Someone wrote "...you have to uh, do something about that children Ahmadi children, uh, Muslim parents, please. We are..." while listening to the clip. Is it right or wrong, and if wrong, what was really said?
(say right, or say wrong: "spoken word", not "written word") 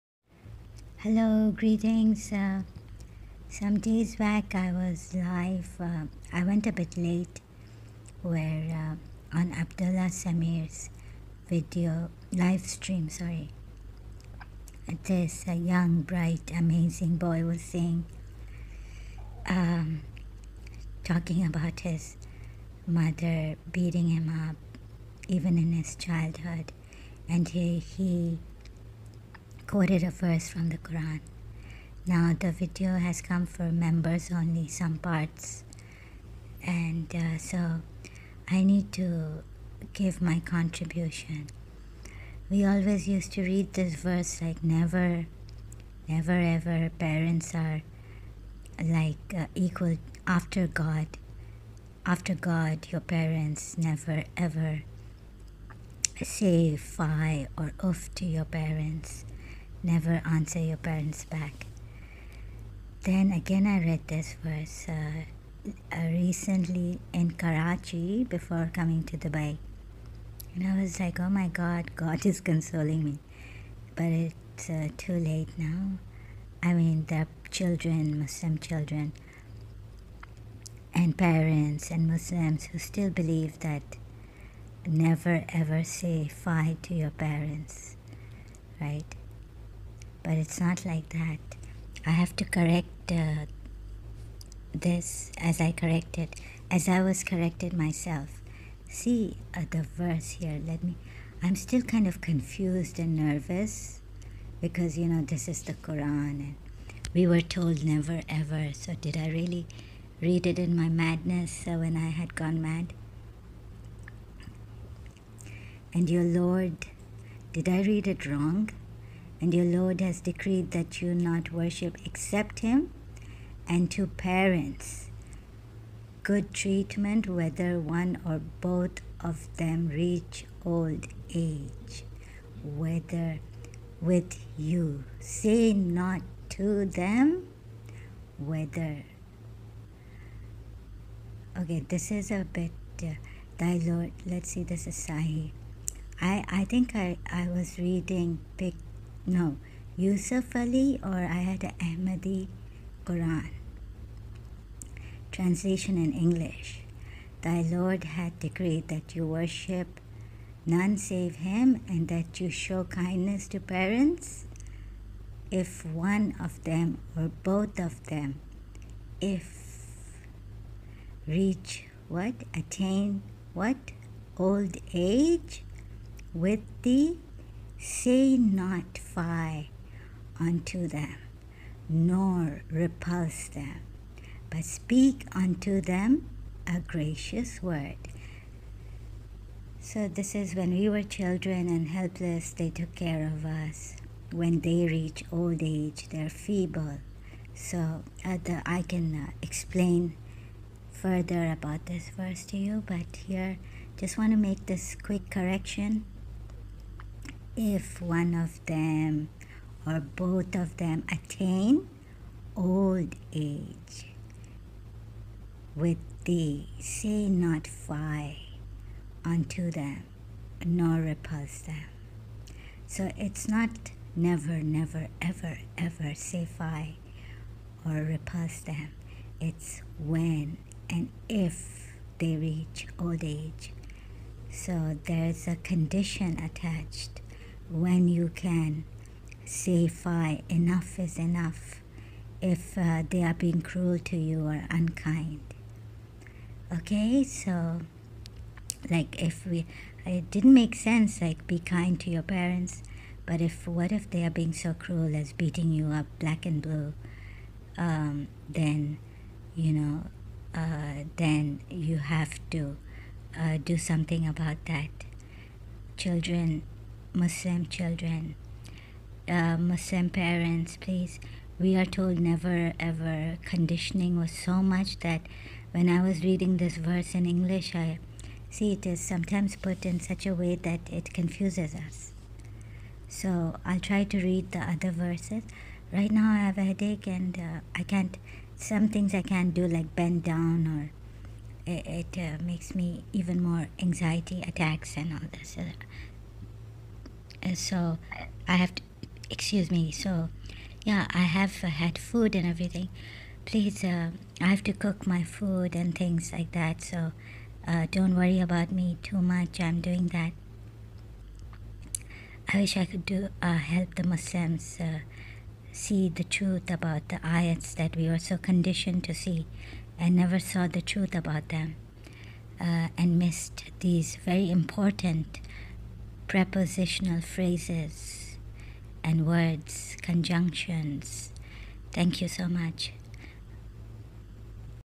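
wrong: "Muslim", not "Ahmadi".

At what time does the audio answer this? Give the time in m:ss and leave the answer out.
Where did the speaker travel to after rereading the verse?
1:09.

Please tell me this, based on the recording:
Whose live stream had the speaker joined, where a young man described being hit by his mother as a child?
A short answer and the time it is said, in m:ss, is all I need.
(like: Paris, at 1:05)
Abdullah Samir, at 0:09.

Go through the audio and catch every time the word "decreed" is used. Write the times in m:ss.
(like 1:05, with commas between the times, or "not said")
2:00, 2:38.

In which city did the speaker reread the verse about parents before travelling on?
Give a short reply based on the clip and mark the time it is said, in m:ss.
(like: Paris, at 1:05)
Karachi, at 1:07.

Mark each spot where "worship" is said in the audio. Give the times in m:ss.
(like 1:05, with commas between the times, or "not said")
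2:01, 2:39.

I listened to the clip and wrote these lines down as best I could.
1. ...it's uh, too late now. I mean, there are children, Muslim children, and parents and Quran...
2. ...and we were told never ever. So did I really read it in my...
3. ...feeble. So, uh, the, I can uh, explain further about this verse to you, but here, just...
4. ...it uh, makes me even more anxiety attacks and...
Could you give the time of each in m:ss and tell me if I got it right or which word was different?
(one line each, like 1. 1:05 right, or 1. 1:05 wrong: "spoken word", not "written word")
1. 1:14 wrong: "Muslims", not "Quran"
2. 1:46 right
3. 3:16 right
4. 4:52 right.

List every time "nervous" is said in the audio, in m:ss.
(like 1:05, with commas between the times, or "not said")
1:43.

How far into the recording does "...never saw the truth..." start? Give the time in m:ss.
5:20.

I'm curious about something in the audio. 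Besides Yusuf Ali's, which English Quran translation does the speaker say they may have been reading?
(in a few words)
Ahmadi.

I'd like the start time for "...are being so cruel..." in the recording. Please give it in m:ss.
4:14.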